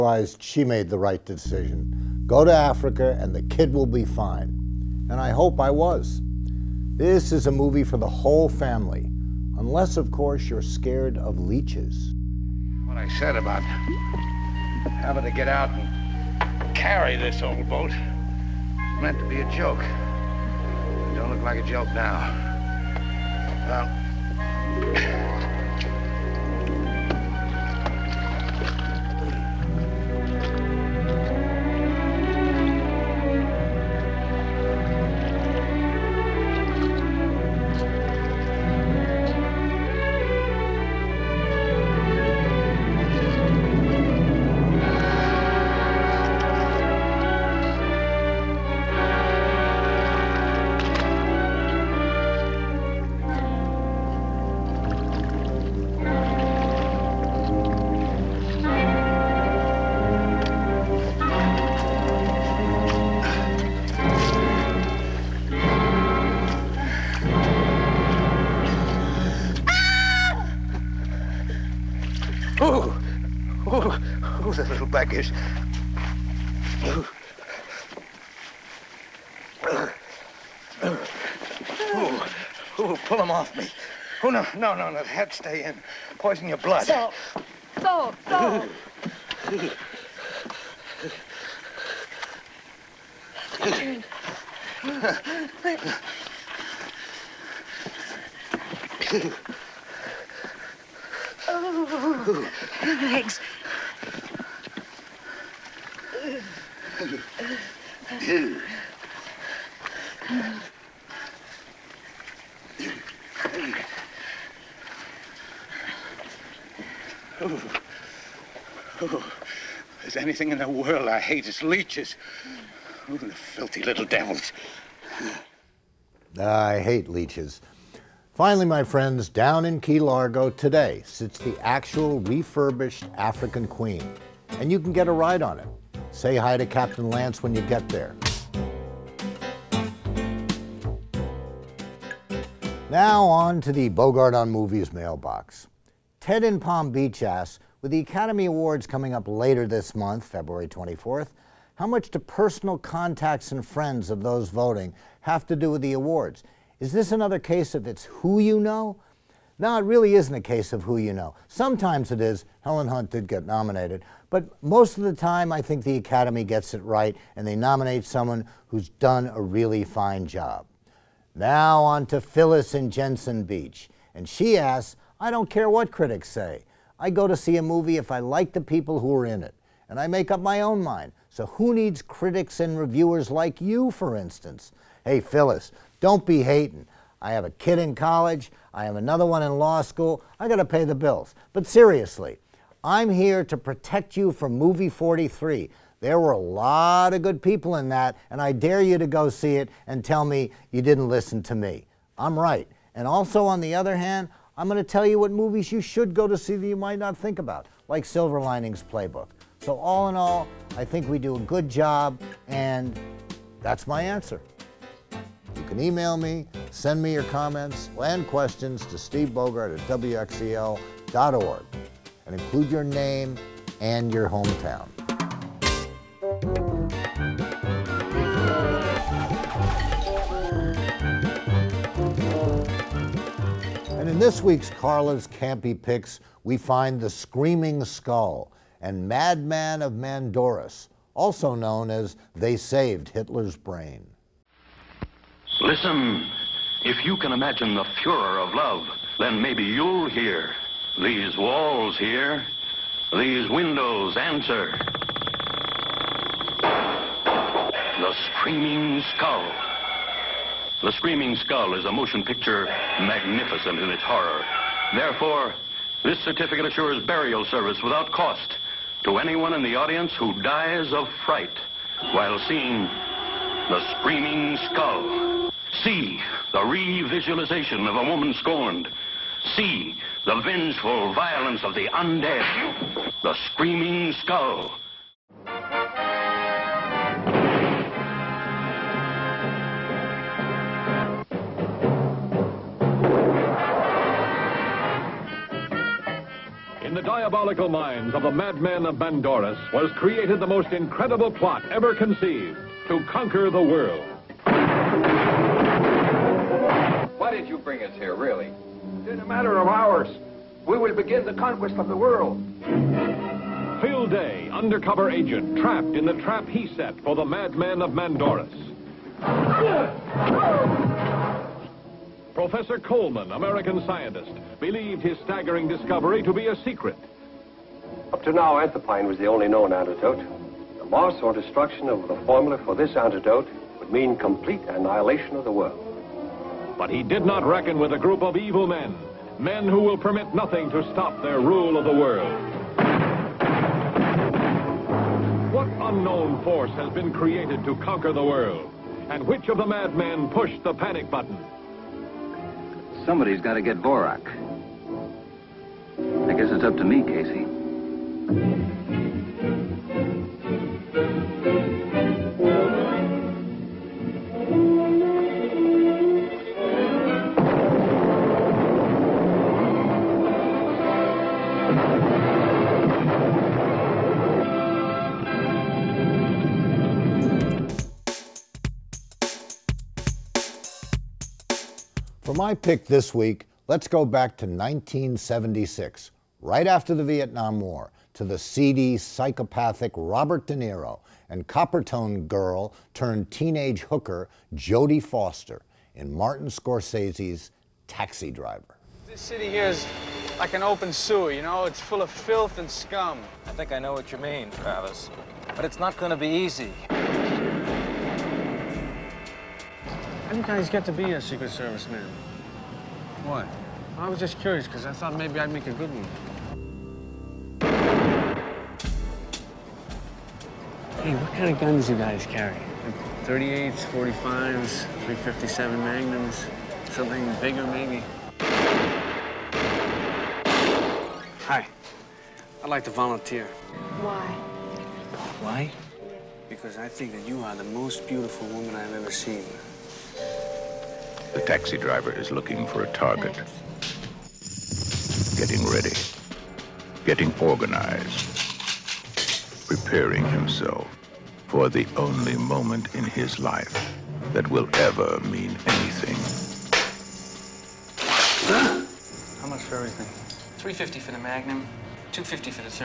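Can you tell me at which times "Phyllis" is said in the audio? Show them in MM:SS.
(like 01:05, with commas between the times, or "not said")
02:52, 03:05.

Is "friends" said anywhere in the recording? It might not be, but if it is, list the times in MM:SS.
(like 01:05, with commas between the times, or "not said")
02:08, 02:33.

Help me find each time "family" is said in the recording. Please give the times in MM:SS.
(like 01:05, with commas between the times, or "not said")
00:08.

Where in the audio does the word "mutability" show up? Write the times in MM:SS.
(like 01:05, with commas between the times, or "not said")
not said.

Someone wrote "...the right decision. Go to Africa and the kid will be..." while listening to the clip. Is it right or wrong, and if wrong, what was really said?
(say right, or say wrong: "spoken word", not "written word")
right.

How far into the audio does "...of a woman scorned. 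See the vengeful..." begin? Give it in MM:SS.
04:37.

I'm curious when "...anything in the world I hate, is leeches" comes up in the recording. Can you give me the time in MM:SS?
02:00.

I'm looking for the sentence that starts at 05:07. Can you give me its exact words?
did you bring us here, really?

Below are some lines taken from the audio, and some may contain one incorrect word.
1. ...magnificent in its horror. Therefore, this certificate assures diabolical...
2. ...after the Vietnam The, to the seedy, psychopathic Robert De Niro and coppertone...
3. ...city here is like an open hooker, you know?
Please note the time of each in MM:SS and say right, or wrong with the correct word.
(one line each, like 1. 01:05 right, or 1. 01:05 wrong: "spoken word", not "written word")
1. 04:23 wrong: "burial", not "diabolical"
2. 06:26 wrong: "War", not "The"
3. 06:39 wrong: "sewer", not "hooker".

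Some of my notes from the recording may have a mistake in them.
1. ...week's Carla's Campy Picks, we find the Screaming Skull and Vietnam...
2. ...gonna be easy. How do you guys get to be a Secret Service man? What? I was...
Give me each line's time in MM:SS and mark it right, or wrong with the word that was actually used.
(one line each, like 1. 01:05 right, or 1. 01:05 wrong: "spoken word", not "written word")
1. 03:54 wrong: "Madman", not "Vietnam"
2. 06:45 right.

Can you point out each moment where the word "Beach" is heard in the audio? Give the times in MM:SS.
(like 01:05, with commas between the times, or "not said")
02:26, 02:53.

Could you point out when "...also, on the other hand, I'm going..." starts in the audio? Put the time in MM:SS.
03:23.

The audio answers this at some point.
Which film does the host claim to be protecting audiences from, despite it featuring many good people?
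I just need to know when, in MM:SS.
03:14.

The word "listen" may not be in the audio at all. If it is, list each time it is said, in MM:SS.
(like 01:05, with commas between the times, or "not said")
03:21, 04:05.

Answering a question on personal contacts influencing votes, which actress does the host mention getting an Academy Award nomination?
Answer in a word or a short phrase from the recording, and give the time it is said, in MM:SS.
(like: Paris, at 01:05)
Helen Hunt, at 02:42.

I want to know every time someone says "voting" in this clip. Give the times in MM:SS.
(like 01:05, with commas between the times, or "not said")
02:34.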